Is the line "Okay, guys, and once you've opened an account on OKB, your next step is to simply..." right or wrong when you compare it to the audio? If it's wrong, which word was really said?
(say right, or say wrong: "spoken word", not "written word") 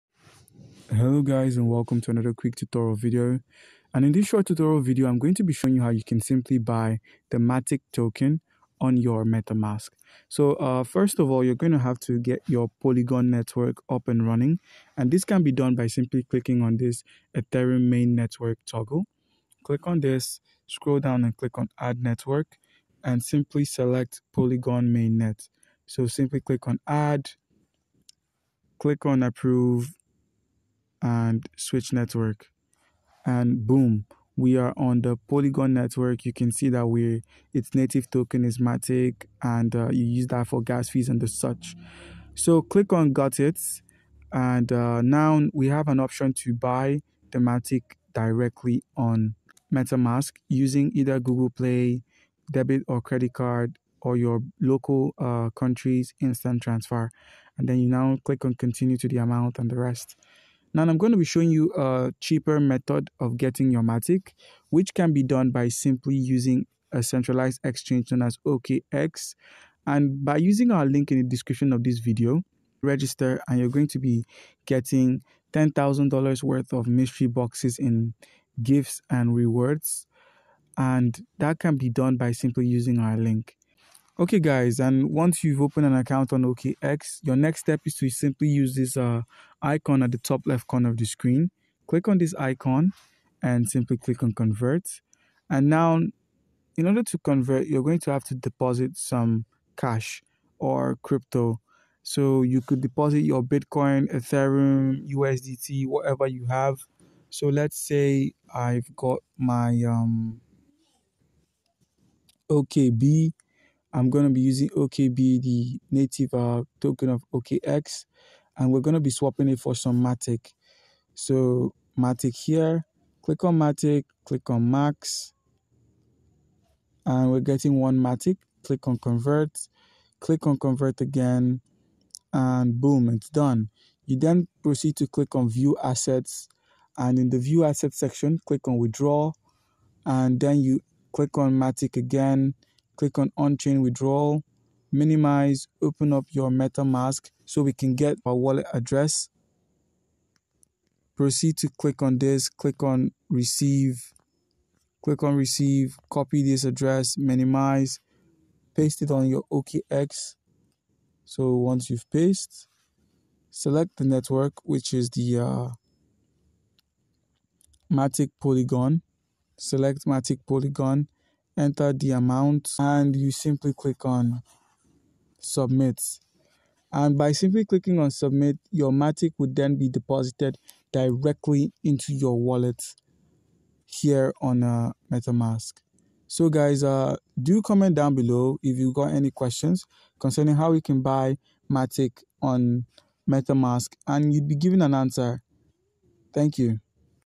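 wrong: "OKX", not "OKB".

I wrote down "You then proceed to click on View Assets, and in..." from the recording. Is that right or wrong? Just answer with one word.
right.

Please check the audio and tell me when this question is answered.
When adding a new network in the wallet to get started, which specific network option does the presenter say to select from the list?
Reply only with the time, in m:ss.
0:24.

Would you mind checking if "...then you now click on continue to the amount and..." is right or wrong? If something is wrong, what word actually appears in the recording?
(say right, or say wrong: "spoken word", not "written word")
right.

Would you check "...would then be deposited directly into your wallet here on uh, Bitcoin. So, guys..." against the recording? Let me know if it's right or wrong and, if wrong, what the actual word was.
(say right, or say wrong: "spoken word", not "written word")
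wrong: "MetaMask", not "Bitcoin".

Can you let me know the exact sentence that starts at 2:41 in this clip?
So once you've pasted, select the network, which is the uh, Matic Polygon.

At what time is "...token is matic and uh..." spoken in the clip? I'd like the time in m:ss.
0:38.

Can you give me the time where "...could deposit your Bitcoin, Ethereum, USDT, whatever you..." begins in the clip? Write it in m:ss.
1:42.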